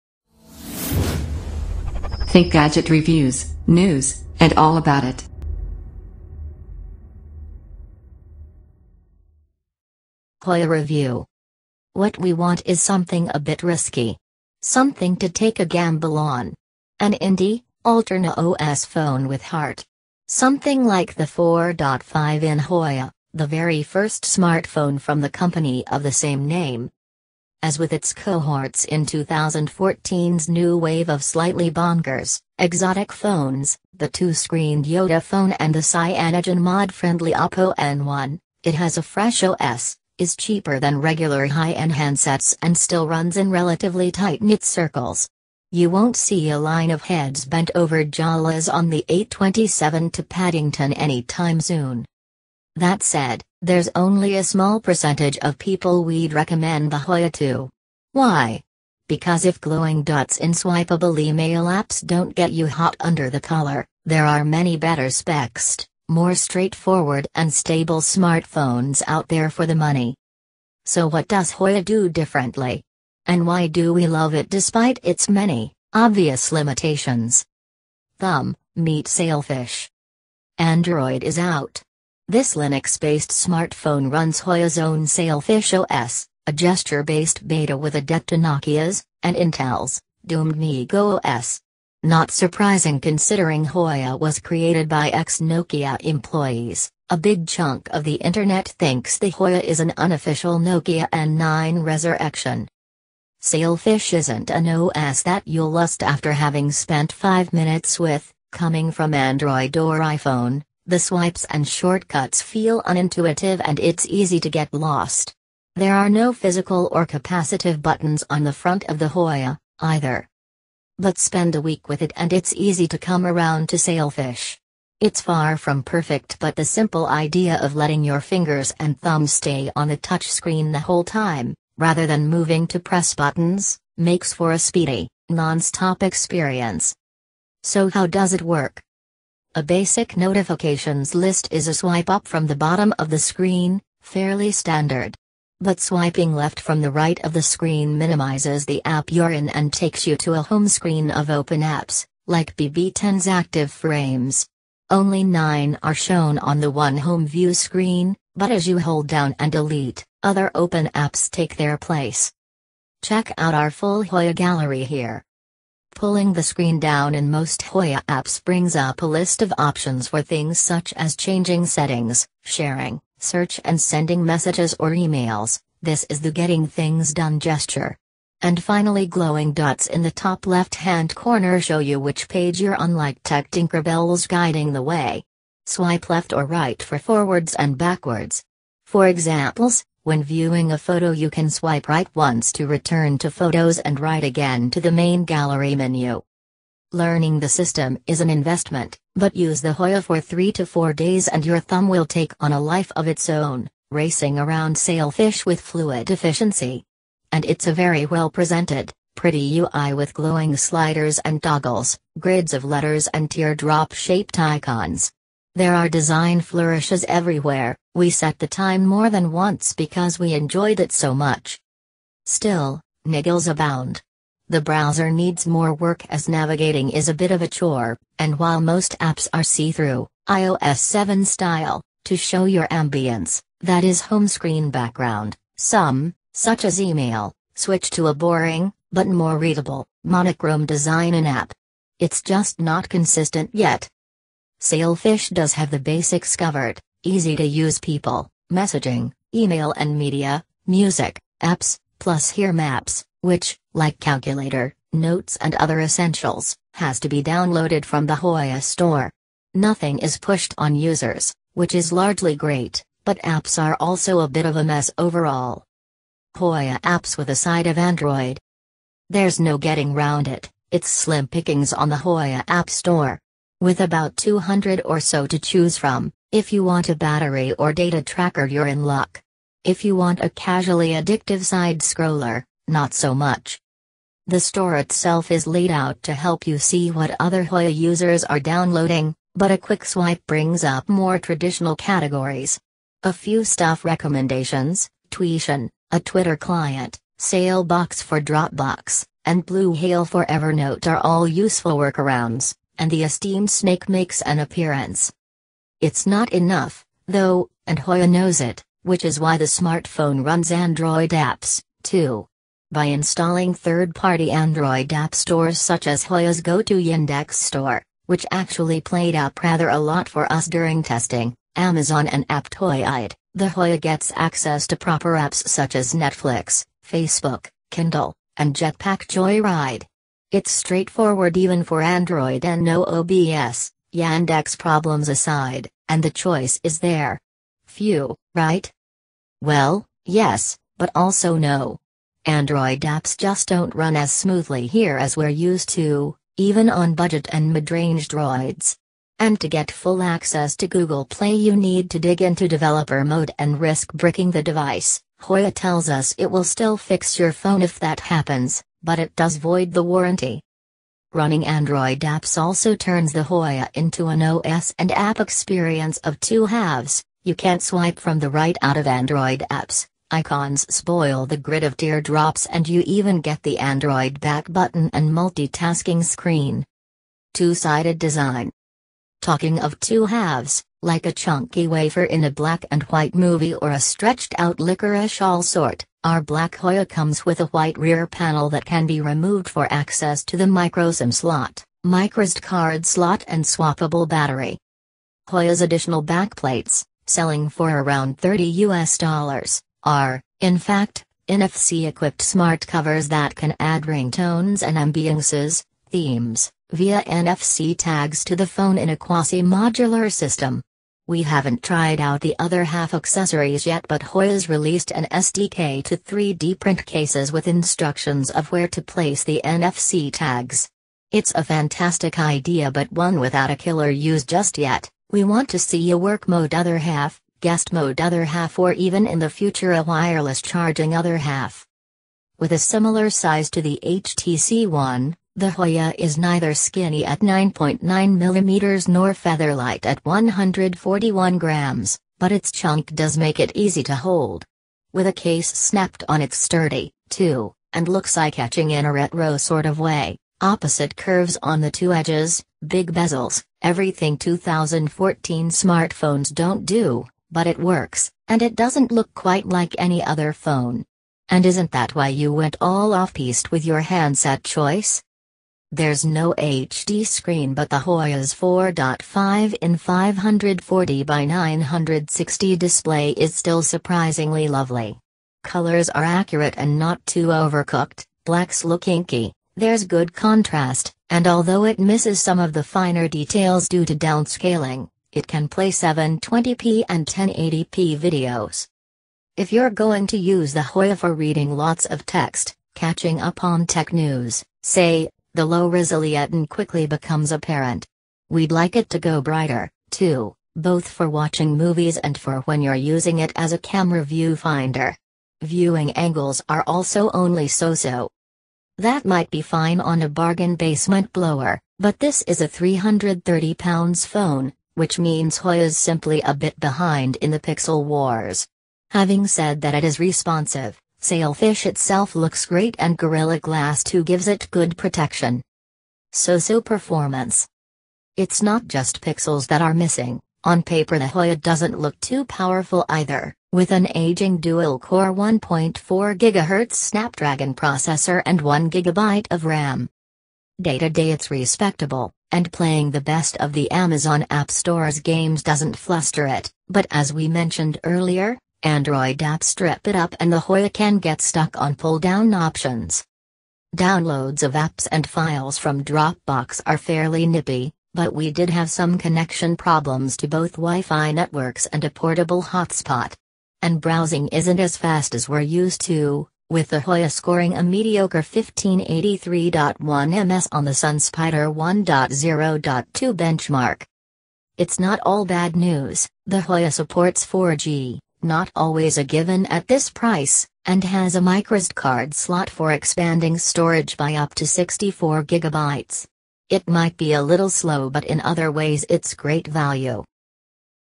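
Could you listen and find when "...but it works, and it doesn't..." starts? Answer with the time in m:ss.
7:37.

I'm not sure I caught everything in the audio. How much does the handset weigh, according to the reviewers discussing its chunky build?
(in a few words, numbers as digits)
141 grams.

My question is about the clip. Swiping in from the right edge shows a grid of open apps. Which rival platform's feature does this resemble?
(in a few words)
BB10.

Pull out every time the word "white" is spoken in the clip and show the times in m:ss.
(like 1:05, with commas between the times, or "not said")
6:22, 6:27.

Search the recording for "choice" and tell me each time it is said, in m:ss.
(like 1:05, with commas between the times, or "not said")
5:36, 7:44.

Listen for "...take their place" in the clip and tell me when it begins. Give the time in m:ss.
2:41.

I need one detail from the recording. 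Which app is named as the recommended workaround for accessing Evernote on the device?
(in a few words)
Blue Hail.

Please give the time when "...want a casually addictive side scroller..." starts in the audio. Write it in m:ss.
4:39.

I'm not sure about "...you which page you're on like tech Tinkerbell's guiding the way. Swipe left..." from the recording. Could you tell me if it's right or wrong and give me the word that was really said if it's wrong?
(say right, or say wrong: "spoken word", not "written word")
right.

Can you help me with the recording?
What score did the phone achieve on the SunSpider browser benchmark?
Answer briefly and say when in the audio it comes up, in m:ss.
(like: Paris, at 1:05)
1583.1 ms, at 9:28.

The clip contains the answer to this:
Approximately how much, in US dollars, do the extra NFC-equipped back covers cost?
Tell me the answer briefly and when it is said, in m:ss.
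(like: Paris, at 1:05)
30 US dollars, at 6:38.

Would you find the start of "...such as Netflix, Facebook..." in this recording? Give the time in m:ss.
5:25.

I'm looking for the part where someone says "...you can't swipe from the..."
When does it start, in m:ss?
6:07.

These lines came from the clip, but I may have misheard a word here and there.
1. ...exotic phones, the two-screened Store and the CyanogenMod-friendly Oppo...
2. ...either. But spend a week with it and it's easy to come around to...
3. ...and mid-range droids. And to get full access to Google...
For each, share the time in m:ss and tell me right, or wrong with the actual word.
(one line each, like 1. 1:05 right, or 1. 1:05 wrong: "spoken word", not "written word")
1. 0:32 wrong: "YotaPhone", not "Store"
2. 1:59 right
3. 5:47 right.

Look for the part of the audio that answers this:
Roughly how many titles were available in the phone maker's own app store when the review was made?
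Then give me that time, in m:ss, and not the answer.
4:34.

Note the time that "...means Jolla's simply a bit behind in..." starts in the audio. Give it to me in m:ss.
8:34.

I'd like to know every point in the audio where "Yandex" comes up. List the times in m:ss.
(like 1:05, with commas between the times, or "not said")
5:16, 5:33.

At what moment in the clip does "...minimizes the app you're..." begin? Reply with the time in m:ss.
2:27.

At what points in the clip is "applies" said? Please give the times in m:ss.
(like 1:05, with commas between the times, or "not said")
not said.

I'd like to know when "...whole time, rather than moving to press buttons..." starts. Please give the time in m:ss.
2:10.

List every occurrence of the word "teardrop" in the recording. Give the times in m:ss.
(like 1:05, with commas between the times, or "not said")
3:33, 6:11.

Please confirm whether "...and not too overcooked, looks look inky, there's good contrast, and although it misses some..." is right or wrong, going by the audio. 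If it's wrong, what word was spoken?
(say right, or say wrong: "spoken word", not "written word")
wrong: "blacks", not "looks".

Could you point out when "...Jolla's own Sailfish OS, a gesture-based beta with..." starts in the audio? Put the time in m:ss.
1:24.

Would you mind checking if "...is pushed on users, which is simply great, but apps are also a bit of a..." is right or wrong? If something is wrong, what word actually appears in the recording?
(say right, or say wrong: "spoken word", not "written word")
wrong: "largely", not "simply".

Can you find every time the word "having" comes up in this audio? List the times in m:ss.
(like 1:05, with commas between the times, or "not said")
1:46, 8:38.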